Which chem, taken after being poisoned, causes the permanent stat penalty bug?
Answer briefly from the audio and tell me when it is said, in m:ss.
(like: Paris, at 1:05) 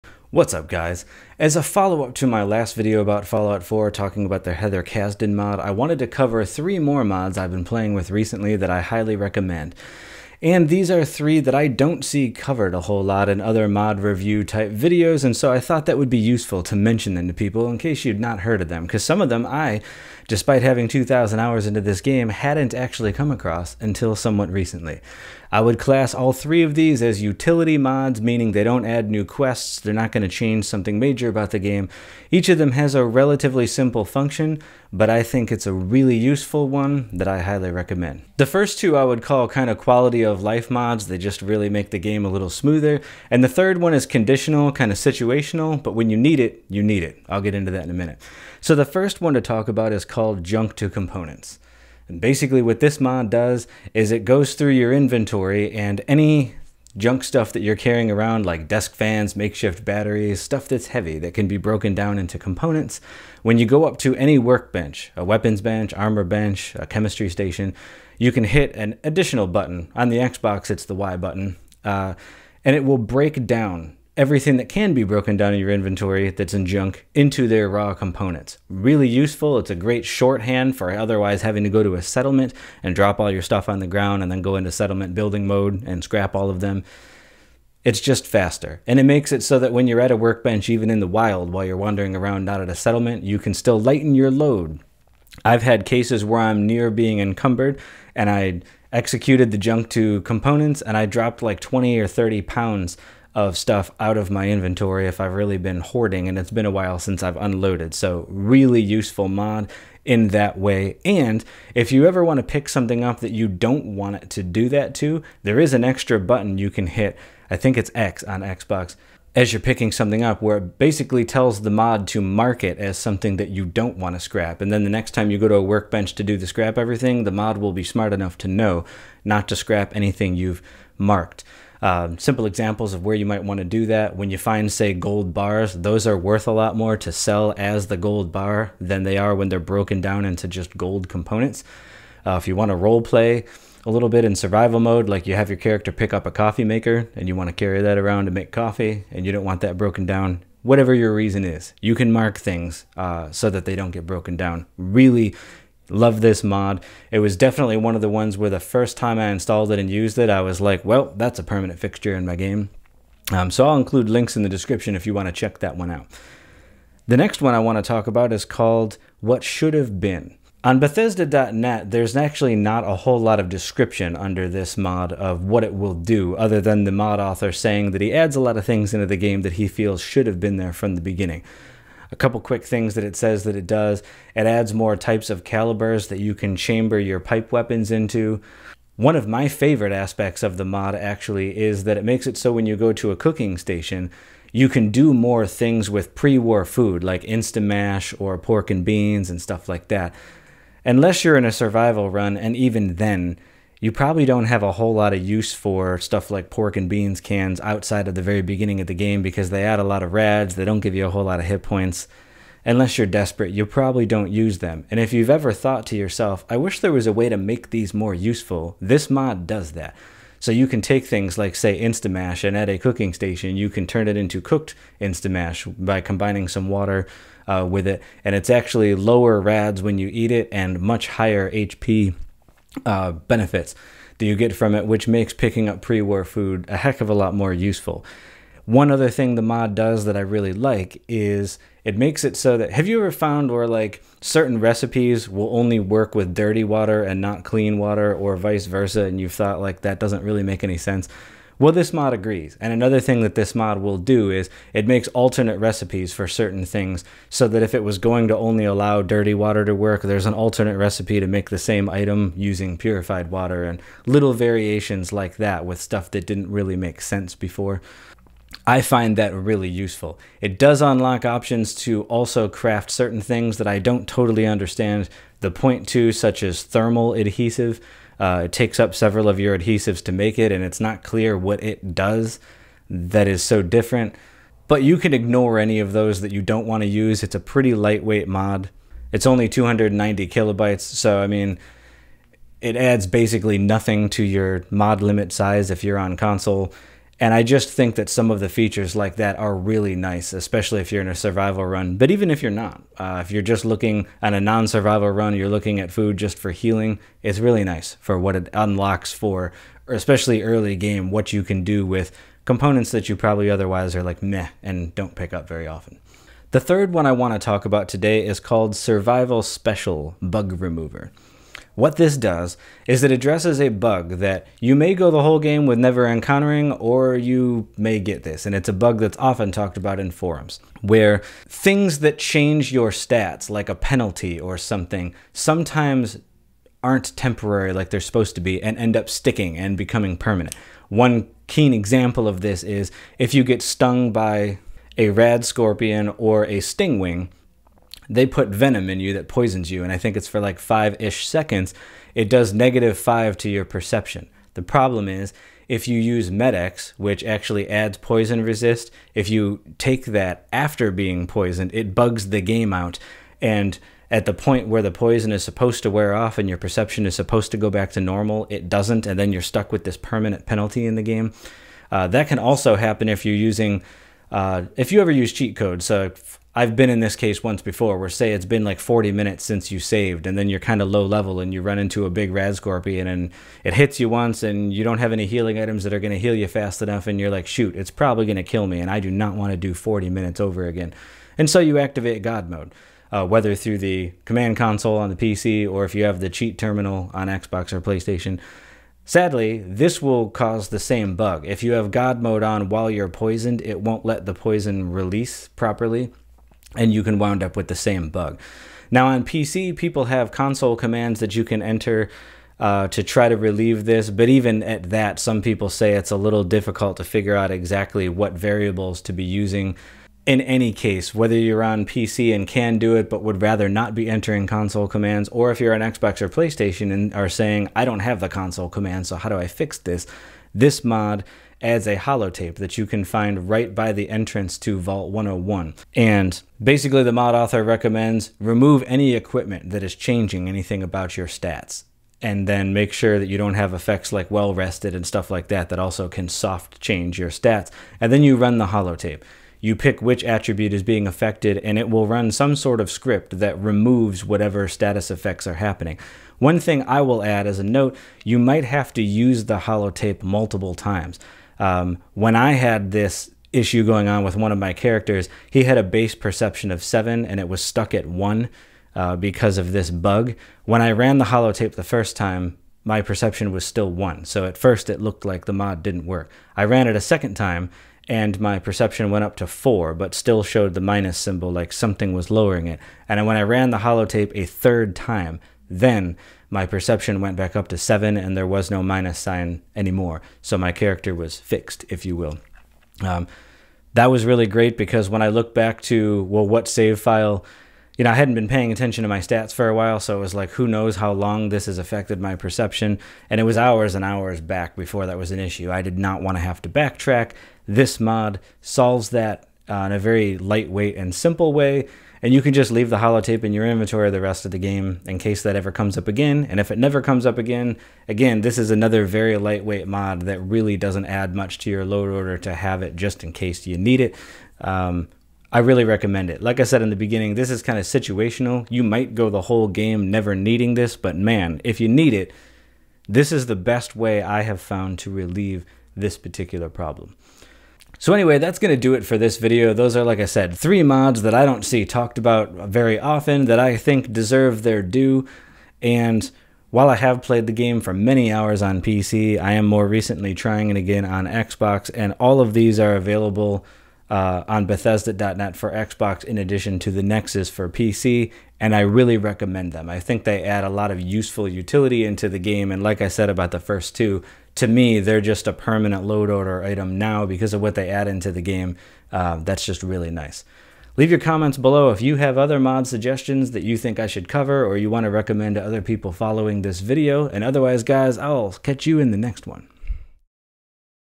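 Med-X, at 5:56.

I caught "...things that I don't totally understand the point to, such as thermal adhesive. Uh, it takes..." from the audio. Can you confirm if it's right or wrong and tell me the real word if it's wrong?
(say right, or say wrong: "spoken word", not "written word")
right.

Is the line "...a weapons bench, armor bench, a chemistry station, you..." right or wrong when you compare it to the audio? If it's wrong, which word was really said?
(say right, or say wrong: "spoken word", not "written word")
right.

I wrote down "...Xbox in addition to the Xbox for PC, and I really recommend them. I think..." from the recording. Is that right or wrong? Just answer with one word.
wrong.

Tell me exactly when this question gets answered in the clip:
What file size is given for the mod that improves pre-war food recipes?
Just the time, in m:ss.
4:49.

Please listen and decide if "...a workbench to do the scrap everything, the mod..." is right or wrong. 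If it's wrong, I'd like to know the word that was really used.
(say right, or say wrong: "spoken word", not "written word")
right.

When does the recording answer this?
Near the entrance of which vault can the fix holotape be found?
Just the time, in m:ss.
7:14.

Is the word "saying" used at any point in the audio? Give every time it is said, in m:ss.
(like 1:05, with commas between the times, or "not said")
2:57, 7:07.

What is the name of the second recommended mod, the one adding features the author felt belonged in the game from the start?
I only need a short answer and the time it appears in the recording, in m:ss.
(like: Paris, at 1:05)
What Should Have Been, at 2:49.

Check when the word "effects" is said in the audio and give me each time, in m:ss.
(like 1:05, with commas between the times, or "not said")
7:23, 7:35.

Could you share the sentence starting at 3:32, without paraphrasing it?
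Unless you're desperate, you probably don't use them.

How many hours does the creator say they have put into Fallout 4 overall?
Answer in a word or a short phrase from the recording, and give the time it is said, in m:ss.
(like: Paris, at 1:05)
2,000, at 0:20.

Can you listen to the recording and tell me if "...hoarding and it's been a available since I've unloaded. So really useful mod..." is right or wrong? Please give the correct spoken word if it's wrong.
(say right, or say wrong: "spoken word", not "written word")
wrong: "while", not "available".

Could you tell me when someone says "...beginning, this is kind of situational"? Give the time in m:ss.
8:46.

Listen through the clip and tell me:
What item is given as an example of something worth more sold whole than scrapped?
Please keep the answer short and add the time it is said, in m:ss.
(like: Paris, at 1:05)
gold bars, at 2:14.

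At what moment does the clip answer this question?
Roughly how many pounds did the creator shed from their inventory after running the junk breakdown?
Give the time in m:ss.
1:41.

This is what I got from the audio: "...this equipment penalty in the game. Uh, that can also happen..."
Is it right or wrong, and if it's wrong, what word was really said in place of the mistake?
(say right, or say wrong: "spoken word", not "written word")
wrong: "permanent", not "equipment".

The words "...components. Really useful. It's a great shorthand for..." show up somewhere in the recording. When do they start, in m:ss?
1:17.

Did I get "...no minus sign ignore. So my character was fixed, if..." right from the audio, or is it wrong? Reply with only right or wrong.
wrong.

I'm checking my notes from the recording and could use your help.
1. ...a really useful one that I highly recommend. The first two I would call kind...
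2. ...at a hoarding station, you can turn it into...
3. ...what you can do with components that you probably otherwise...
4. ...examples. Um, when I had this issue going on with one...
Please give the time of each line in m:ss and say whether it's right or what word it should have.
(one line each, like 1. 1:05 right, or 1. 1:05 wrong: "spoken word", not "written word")
1. 0:35 right
2. 3:42 wrong: "cooking", not "hoarding"
3. 5:11 right
4. 7:40 wrong: "times", not "examples".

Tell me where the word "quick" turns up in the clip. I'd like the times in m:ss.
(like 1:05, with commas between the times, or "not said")
3:02.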